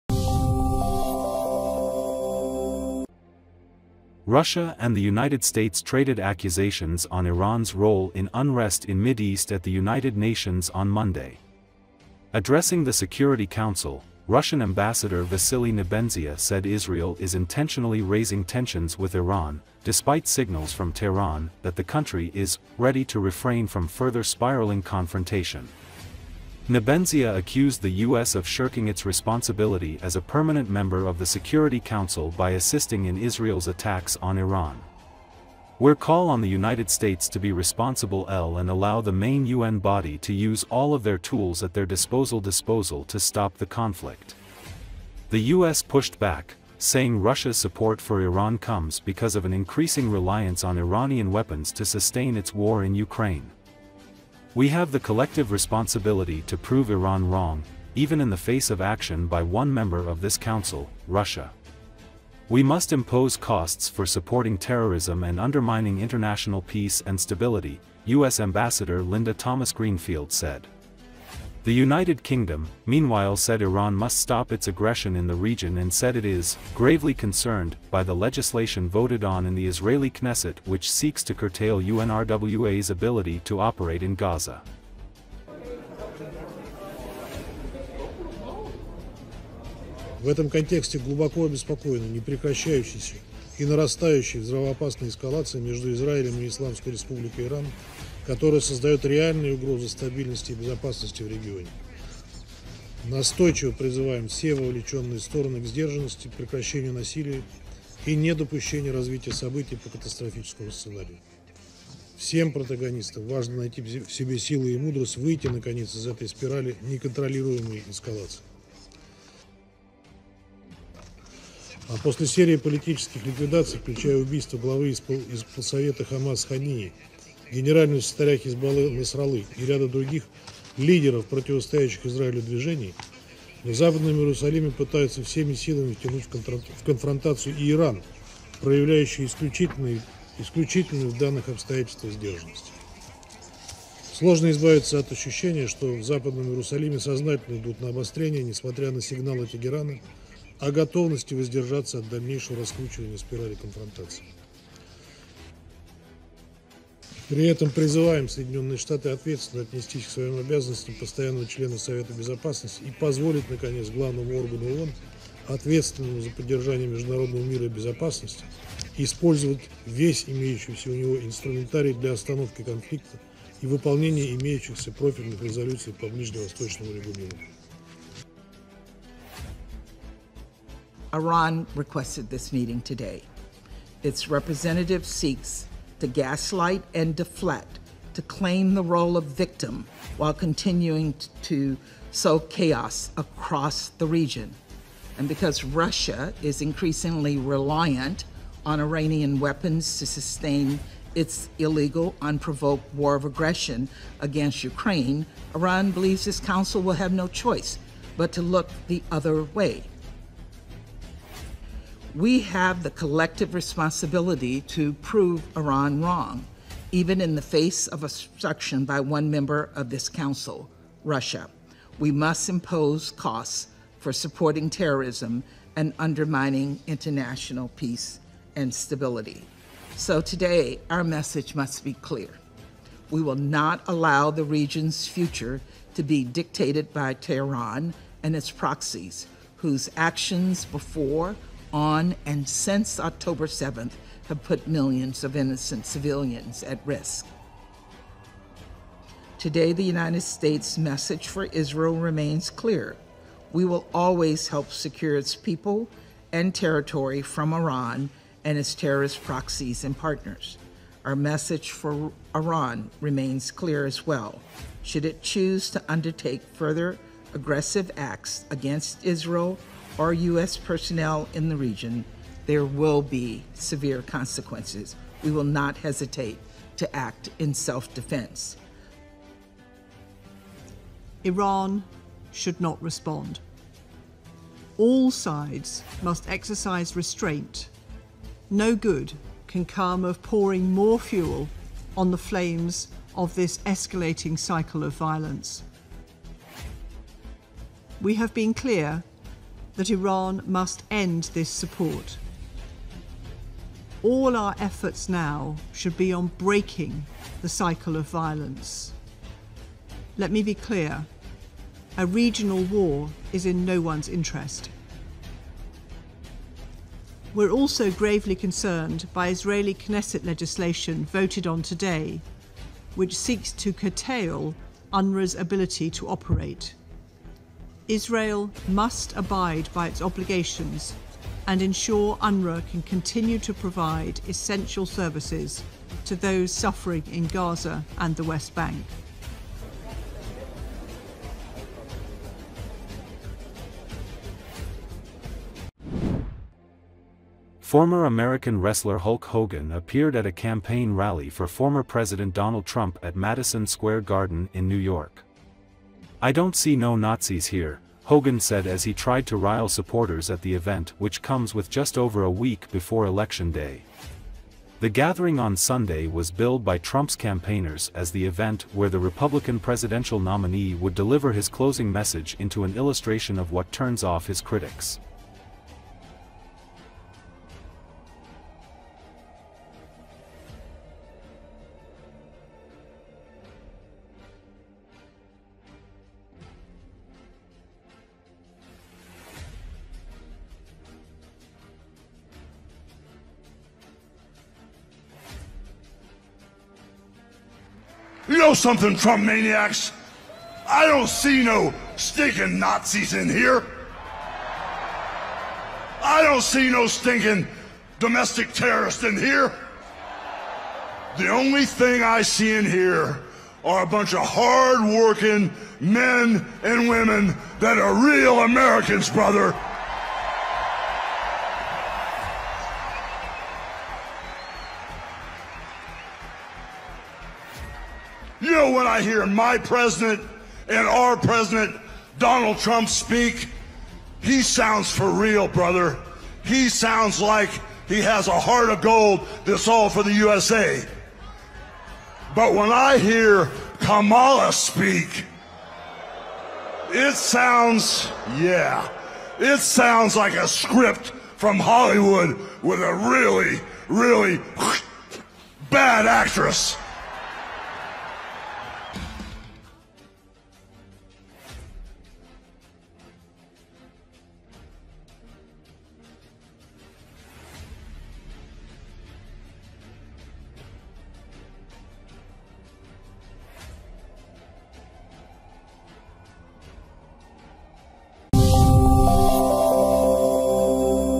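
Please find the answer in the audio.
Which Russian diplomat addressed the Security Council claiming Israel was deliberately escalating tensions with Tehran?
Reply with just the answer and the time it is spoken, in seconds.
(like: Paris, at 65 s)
Vasily Nebenzia, at 15 s.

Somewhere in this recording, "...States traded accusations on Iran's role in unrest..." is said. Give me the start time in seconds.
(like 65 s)
5 s.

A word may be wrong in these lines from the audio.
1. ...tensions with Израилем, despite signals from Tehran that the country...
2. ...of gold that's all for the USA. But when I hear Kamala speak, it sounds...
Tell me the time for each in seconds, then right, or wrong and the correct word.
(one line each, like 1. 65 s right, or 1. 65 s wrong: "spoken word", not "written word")
1. 18 s wrong: "Iran", not "Израилем"
2. 438 s right.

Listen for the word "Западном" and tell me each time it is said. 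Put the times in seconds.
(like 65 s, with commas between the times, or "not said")
133 s, 146 s.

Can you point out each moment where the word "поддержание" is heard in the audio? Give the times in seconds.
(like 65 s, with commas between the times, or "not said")
166 s.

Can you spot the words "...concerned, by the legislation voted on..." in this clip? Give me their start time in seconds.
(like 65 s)
77 s.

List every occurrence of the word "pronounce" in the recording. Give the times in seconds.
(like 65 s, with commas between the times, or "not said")
not said.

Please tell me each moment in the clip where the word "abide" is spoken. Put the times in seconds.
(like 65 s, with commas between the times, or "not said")
329 s.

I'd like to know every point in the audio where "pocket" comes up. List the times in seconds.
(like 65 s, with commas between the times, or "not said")
not said.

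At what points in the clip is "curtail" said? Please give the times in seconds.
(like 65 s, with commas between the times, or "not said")
81 s, 323 s.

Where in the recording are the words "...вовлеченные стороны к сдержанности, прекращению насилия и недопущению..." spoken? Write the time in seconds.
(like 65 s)
104 s.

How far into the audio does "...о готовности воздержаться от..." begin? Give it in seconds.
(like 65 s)
150 s.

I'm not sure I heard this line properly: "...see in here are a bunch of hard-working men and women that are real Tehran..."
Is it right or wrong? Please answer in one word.
wrong.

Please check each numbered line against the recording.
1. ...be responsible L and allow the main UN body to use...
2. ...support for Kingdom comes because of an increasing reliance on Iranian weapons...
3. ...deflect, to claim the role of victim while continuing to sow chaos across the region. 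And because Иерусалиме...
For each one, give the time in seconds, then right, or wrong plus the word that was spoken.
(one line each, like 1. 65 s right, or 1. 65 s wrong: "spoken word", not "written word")
1. 37 s right
2. 47 s wrong: "Iran", not "Kingdom"
3. 187 s wrong: "Russia", not "Иерусалиме".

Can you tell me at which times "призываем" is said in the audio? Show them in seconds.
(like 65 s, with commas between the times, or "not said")
103 s, 157 s.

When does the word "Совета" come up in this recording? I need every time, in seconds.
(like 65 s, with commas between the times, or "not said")
125 s, 161 s.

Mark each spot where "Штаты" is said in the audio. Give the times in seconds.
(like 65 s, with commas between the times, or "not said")
158 s.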